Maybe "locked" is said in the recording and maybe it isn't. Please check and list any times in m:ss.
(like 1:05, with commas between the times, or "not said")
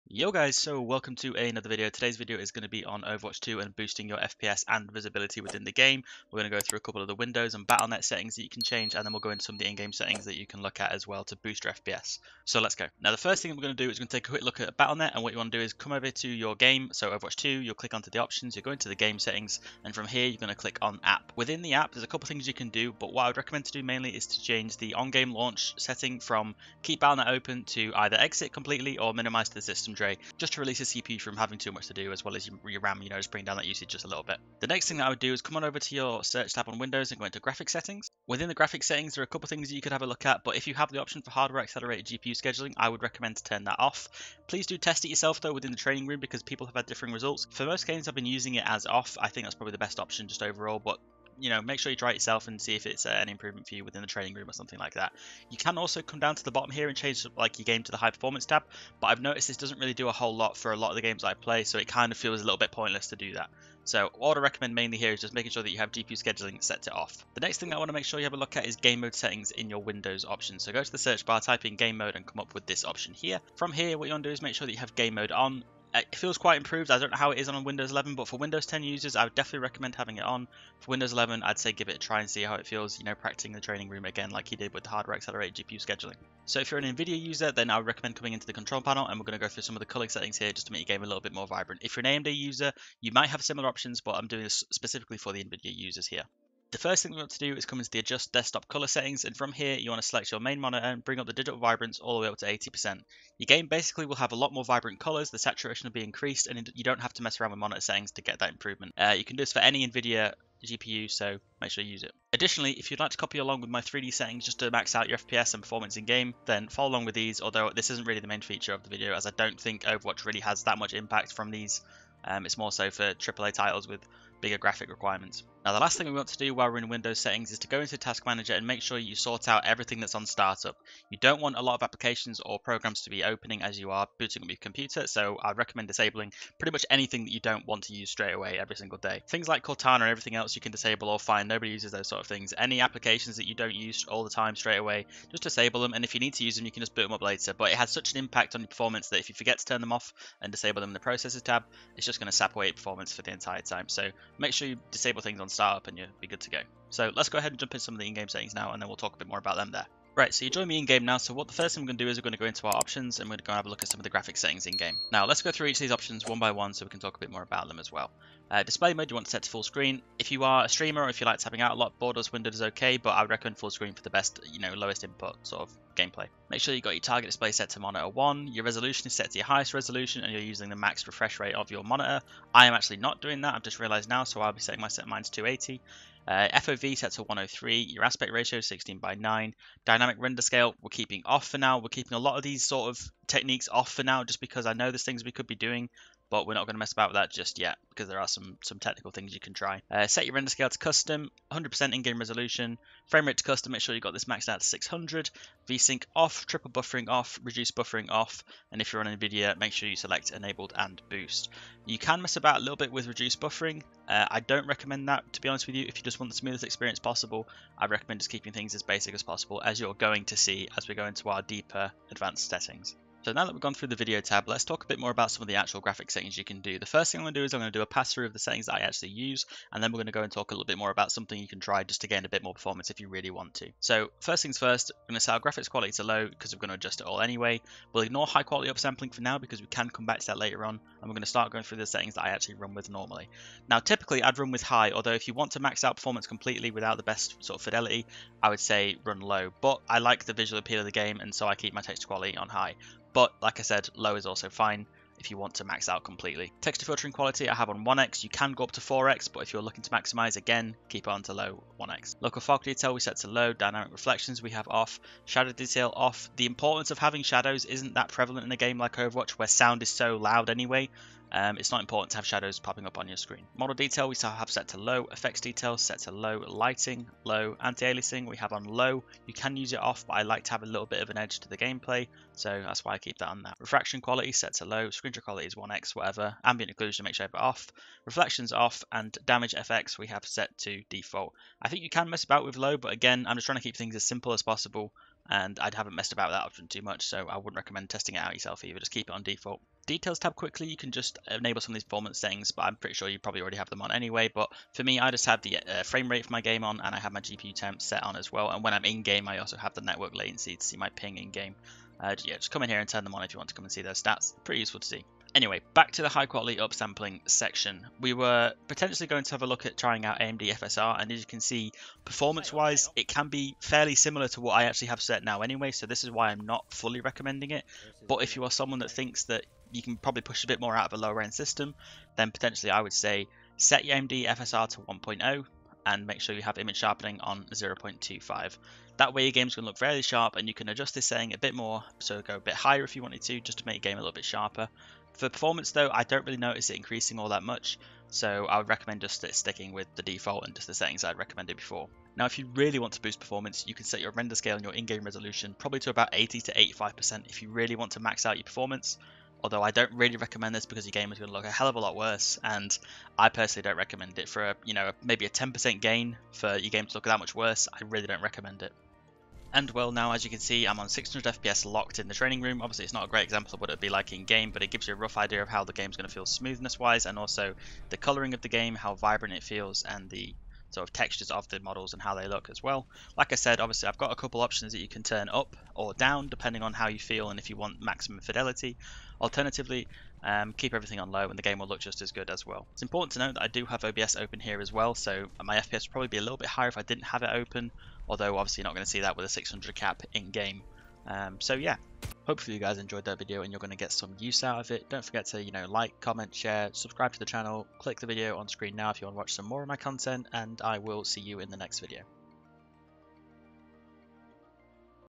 6:11.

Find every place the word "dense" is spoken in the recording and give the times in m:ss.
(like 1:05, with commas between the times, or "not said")
not said.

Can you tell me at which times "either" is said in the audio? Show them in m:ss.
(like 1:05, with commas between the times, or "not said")
0:27, 4:58.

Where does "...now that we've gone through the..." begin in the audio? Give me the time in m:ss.
3:43.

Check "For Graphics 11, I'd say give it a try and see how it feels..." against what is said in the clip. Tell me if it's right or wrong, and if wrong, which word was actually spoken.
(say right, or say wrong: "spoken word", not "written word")
wrong: "Windows", not "Graphics".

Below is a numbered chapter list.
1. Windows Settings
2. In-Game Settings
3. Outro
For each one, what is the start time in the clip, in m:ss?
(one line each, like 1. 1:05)
1. 0:14
2. 2:40
3. 6:42.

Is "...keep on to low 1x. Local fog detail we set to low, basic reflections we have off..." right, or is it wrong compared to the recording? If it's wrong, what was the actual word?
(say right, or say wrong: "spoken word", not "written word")
wrong: "dynamic", not "basic".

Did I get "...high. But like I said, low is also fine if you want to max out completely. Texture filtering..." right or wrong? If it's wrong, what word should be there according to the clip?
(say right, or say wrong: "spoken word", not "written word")
right.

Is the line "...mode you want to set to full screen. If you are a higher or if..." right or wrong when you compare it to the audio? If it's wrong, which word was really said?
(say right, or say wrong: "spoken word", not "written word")
wrong: "streamer", not "higher".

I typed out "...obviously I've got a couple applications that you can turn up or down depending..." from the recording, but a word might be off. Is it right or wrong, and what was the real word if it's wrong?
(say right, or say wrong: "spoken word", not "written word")
wrong: "options", not "applications".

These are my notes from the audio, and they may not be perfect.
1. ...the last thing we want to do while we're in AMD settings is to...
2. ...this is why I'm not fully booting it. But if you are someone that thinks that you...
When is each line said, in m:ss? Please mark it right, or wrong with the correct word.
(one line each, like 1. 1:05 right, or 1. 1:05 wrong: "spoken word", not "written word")
1. 2:05 wrong: "Windows", not "AMD"
2. 5:25 wrong: "recommending", not "booting".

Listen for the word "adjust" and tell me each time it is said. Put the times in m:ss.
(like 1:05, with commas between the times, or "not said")
1:37, 3:56, 5:40.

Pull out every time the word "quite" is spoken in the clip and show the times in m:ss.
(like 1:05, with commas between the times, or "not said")
1:16.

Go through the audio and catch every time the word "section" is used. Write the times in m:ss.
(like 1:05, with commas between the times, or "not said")
5:17.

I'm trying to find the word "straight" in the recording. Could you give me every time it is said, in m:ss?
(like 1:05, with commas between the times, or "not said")
2:18, 2:24.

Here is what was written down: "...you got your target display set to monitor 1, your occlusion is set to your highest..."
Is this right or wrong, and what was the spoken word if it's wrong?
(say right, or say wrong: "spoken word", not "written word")
wrong: "resolution", not "occlusion".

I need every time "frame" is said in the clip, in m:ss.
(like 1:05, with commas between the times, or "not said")
3:23, 5:05.